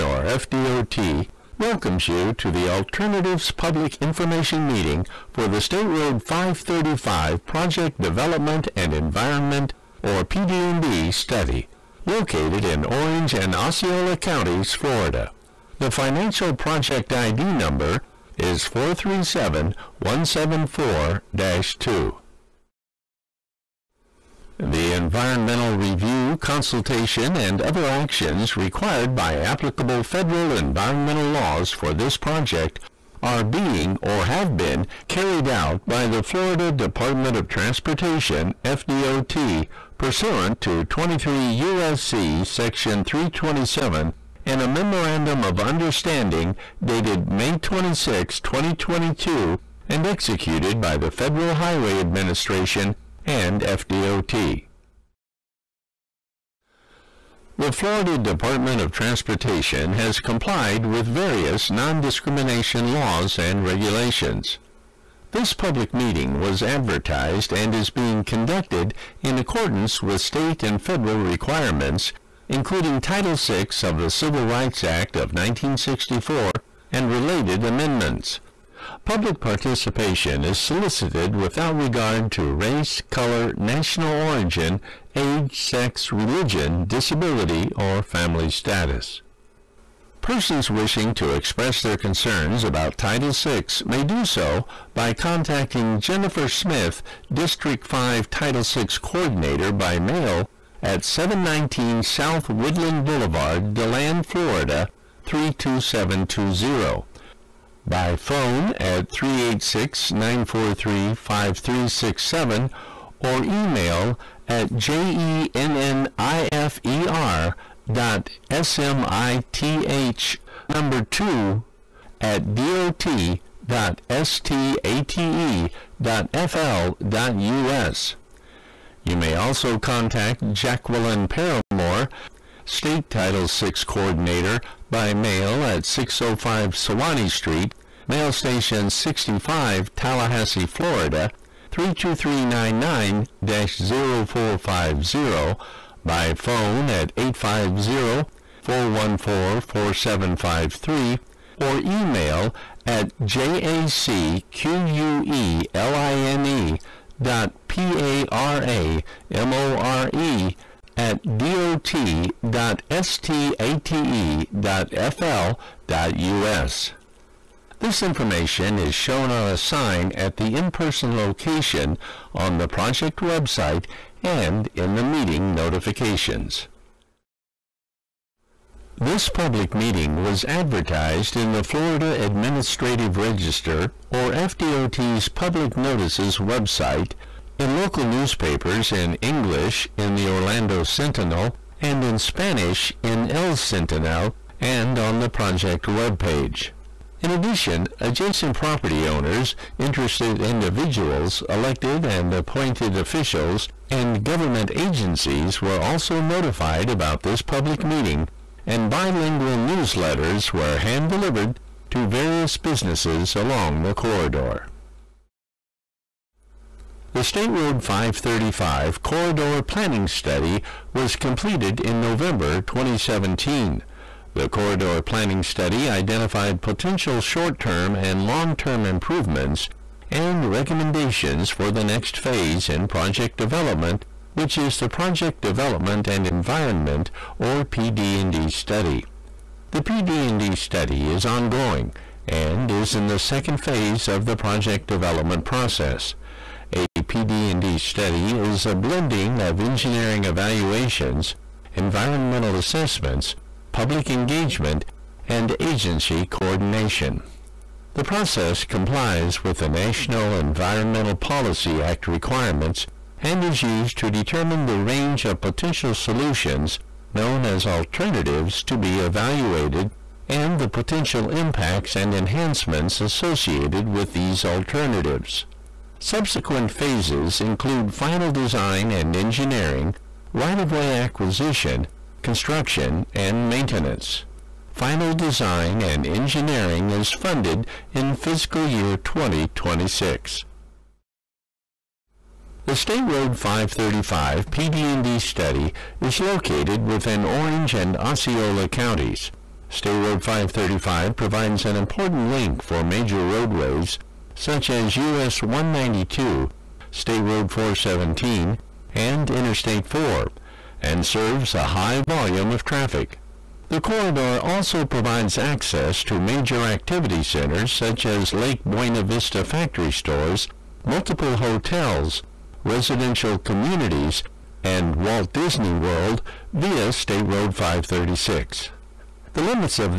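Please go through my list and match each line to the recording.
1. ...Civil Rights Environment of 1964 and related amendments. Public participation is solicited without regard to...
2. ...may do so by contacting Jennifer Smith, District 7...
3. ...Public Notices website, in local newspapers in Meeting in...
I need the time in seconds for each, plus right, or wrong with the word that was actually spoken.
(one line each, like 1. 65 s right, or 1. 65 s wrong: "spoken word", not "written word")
1. 74 s wrong: "Act", not "Environment"
2. 93 s wrong: "5", not "7"
3. 185 s wrong: "English", not "Meeting".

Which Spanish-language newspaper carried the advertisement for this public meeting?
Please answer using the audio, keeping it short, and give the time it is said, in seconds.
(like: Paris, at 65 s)
El Sentinel, at 193 s.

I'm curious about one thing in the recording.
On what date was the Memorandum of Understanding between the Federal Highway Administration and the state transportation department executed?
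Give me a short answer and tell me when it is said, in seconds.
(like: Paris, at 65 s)
May 26, 2022, at 47 s.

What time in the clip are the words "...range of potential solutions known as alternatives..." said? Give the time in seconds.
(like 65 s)
264 s.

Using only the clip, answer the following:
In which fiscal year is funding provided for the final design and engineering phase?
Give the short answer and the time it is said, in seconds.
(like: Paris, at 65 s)
2026, at 288 s.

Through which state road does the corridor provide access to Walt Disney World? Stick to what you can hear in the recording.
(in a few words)
State Road 536.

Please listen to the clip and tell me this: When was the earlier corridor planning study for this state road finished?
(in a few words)
November 2017.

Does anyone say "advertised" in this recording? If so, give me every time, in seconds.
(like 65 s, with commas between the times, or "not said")
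66 s, 180 s.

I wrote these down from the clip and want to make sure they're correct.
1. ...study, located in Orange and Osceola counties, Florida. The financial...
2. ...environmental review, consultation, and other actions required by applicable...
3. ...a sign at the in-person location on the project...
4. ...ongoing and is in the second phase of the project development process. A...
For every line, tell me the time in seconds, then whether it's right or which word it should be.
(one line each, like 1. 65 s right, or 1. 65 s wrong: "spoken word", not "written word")
1. 11 s right
2. 24 s right
3. 169 s right
4. 241 s right.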